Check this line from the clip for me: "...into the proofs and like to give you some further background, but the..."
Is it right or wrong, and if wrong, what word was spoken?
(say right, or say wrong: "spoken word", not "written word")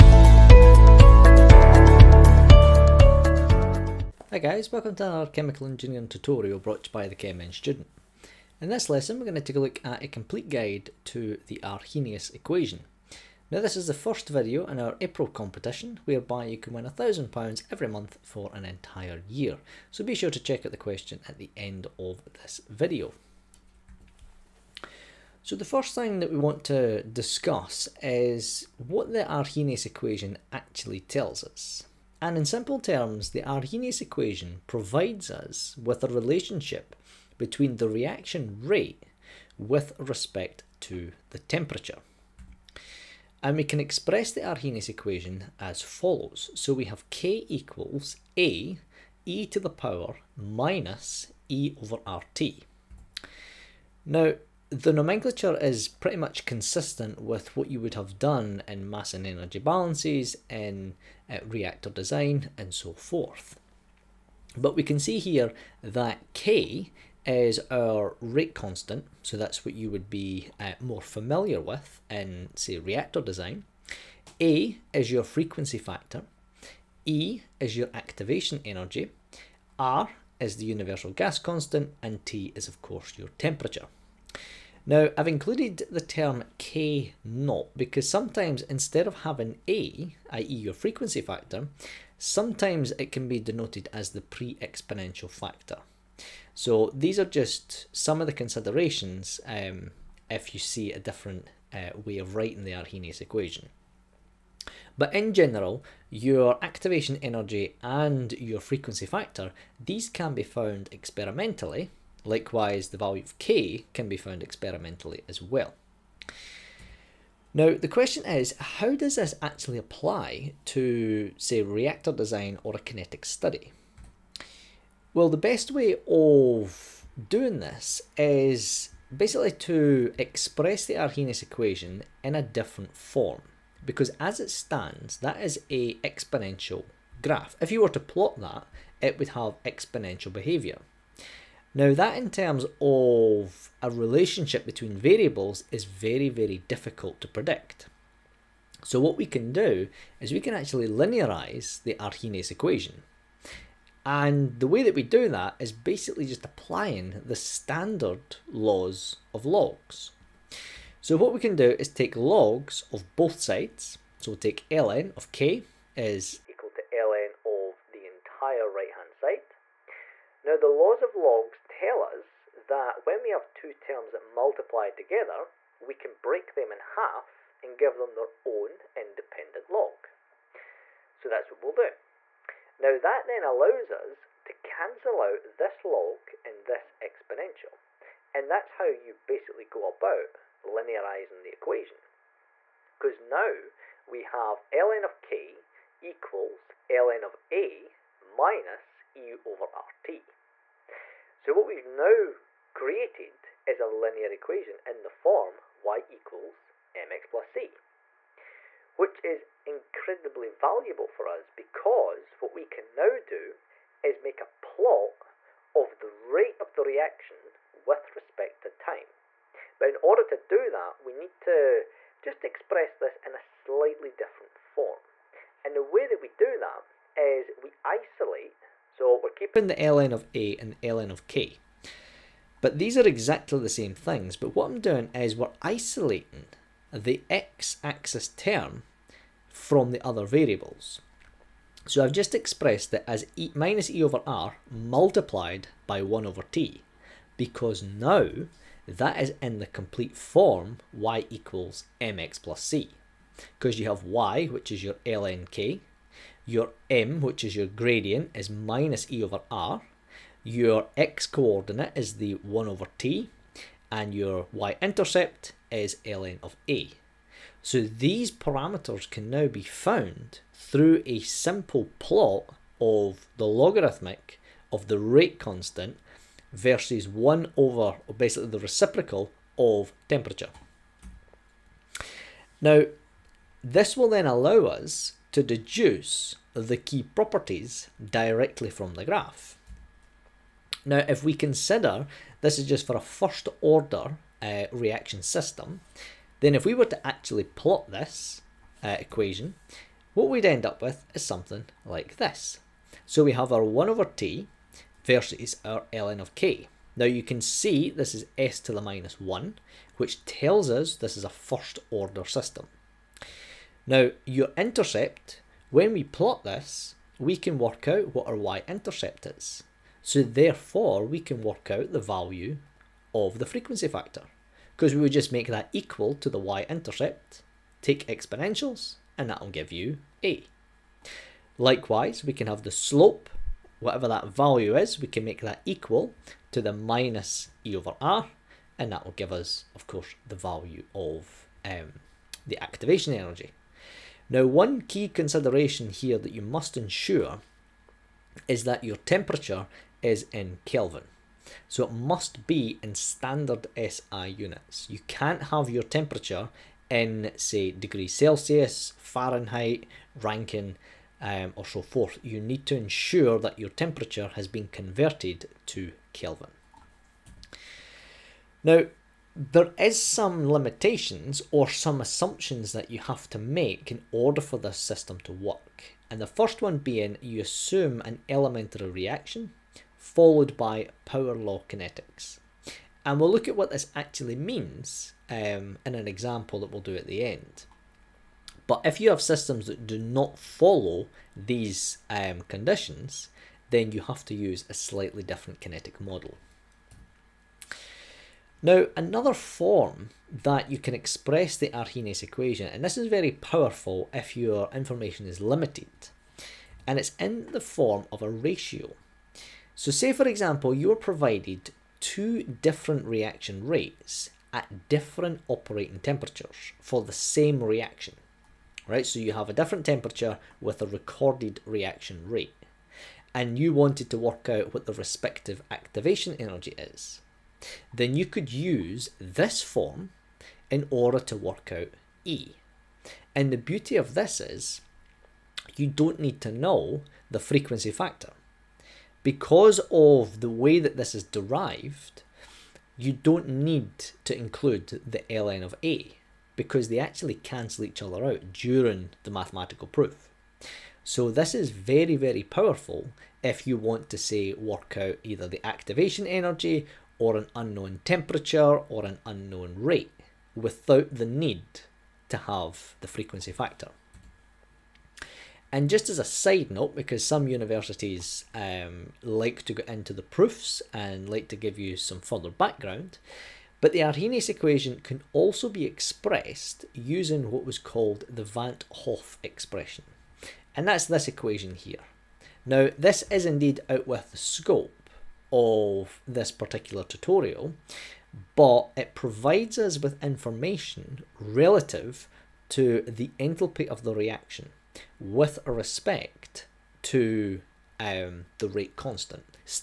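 right.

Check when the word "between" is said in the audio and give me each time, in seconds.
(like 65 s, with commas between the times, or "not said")
37 s, 144 s.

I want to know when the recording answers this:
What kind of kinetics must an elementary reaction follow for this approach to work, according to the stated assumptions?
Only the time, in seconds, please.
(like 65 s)
381 s.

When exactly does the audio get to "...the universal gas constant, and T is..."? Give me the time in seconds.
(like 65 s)
80 s.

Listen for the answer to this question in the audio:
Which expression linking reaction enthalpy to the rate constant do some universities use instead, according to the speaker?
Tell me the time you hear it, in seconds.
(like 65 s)
478 s.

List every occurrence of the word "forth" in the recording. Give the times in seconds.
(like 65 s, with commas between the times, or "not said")
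62 s, 361 s.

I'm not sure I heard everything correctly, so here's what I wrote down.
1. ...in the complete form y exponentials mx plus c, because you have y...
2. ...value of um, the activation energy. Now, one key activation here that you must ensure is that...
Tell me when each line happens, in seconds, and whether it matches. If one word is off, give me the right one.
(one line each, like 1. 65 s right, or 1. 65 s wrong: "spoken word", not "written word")
1. 249 s wrong: "equals", not "exponentials"
2. 340 s wrong: "consideration", not "activation".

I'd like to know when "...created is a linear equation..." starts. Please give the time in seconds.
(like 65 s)
202 s.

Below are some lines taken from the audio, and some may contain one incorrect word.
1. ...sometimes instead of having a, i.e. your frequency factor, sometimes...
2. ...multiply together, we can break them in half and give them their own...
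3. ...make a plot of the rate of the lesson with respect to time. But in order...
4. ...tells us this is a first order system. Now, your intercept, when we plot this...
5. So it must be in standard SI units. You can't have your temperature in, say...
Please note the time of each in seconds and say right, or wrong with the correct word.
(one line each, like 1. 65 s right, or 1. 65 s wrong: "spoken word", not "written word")
1. 88 s right
2. 174 s right
3. 214 s wrong: "reaction", not "lesson"
4. 310 s right
5. 351 s right.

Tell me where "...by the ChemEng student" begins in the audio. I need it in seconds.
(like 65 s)
6 s.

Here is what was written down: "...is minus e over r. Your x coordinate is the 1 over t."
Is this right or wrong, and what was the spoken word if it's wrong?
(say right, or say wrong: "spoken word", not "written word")
right.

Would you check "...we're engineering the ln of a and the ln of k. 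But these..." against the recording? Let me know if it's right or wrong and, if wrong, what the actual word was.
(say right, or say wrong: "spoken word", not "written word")
wrong: "keeping", not "engineering".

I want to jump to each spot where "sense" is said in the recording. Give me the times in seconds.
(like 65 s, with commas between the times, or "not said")
not said.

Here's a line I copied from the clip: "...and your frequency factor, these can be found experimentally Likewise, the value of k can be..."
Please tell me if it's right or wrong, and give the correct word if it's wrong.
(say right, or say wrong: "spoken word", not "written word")
right.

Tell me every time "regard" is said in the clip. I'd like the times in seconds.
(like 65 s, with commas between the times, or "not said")
not said.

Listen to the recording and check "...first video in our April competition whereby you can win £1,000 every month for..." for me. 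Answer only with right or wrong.
right.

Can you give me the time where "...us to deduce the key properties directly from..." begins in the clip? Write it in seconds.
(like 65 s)
284 s.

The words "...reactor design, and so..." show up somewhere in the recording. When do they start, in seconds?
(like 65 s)
61 s.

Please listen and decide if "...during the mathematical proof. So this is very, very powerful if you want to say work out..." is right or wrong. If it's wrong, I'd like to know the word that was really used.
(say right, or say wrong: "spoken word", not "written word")
right.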